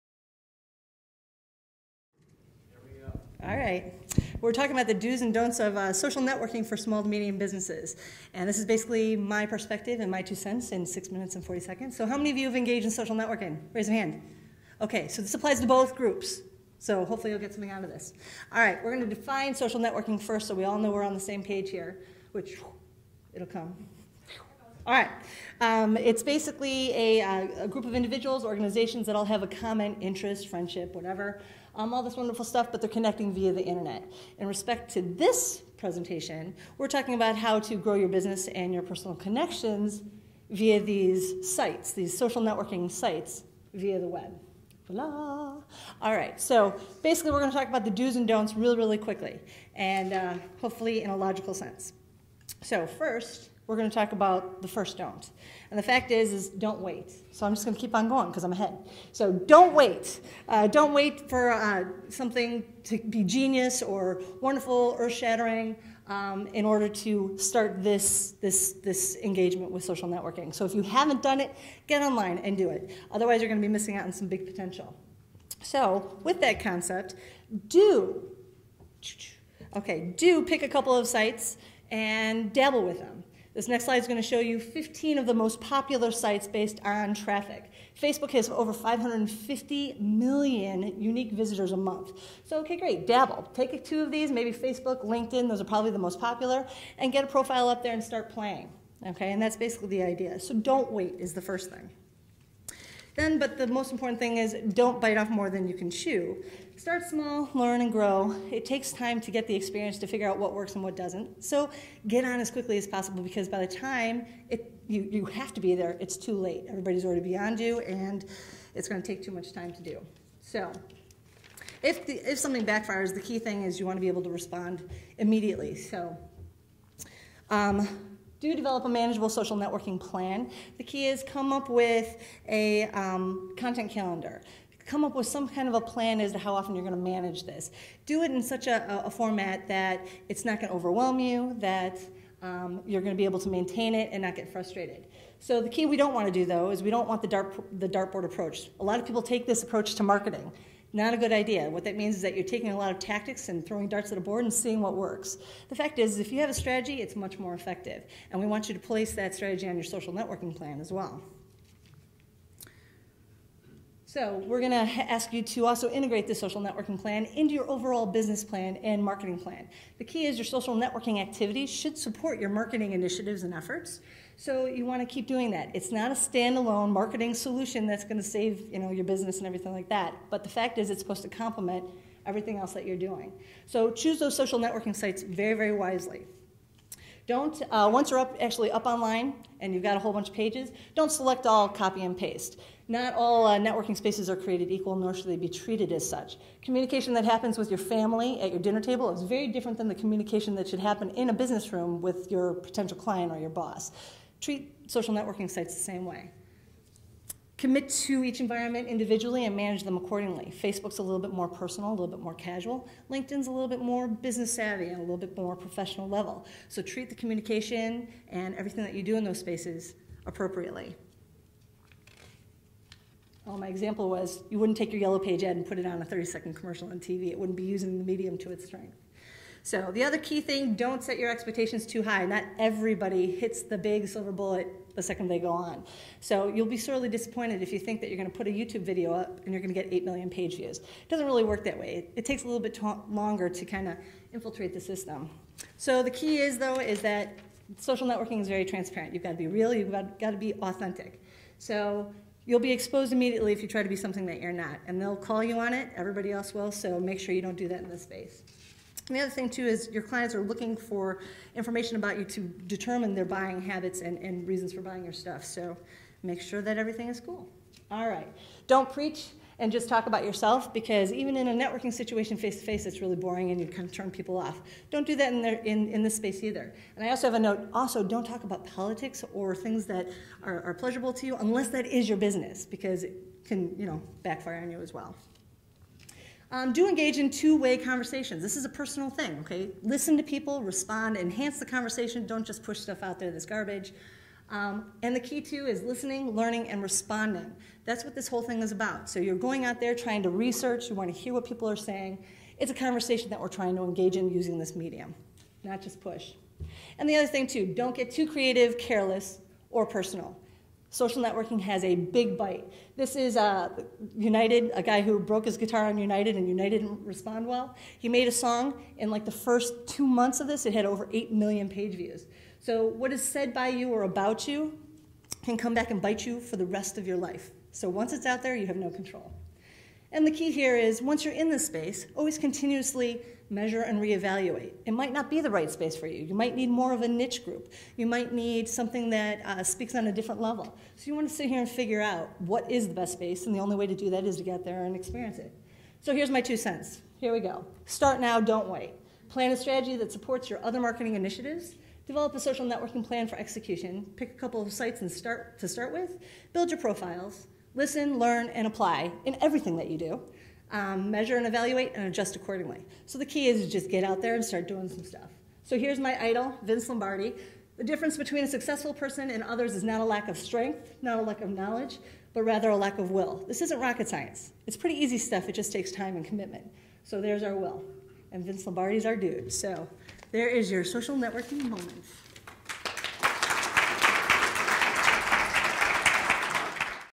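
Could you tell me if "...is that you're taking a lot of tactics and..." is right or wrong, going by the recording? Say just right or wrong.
right.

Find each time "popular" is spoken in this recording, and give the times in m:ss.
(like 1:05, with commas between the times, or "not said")
1:25, 1:36.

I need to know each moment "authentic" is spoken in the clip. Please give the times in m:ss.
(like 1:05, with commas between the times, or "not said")
4:10.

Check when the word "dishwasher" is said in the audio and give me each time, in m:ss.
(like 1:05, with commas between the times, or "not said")
not said.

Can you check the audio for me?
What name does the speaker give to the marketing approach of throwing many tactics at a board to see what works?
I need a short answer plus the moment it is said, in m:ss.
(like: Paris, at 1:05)
dartboard approach, at 2:27.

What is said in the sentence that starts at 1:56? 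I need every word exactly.
Everybody's already beyond you and it's gonna take too much time to do.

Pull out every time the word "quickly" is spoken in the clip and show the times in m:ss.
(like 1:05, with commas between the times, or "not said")
0:48, 1:52.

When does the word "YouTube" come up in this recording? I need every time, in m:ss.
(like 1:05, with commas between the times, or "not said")
3:58.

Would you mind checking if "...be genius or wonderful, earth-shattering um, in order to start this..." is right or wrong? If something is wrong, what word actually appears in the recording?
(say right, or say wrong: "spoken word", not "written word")
right.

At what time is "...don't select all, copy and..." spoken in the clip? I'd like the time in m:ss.
3:10.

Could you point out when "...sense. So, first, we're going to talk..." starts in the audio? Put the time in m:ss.
0:51.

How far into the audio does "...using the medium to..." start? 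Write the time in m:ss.
3:47.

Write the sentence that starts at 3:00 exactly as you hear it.
But the fact is it's supposed to complement everything else that you're doing.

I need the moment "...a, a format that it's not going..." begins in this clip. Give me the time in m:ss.
2:18.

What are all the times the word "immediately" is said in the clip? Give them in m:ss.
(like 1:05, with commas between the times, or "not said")
2:05, 4:13.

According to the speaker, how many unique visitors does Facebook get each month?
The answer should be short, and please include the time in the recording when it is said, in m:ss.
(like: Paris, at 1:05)
over 550 million, at 1:28.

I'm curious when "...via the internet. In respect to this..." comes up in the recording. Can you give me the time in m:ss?
0:33.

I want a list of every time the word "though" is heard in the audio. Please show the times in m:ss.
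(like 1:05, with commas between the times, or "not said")
2:26, 4:06.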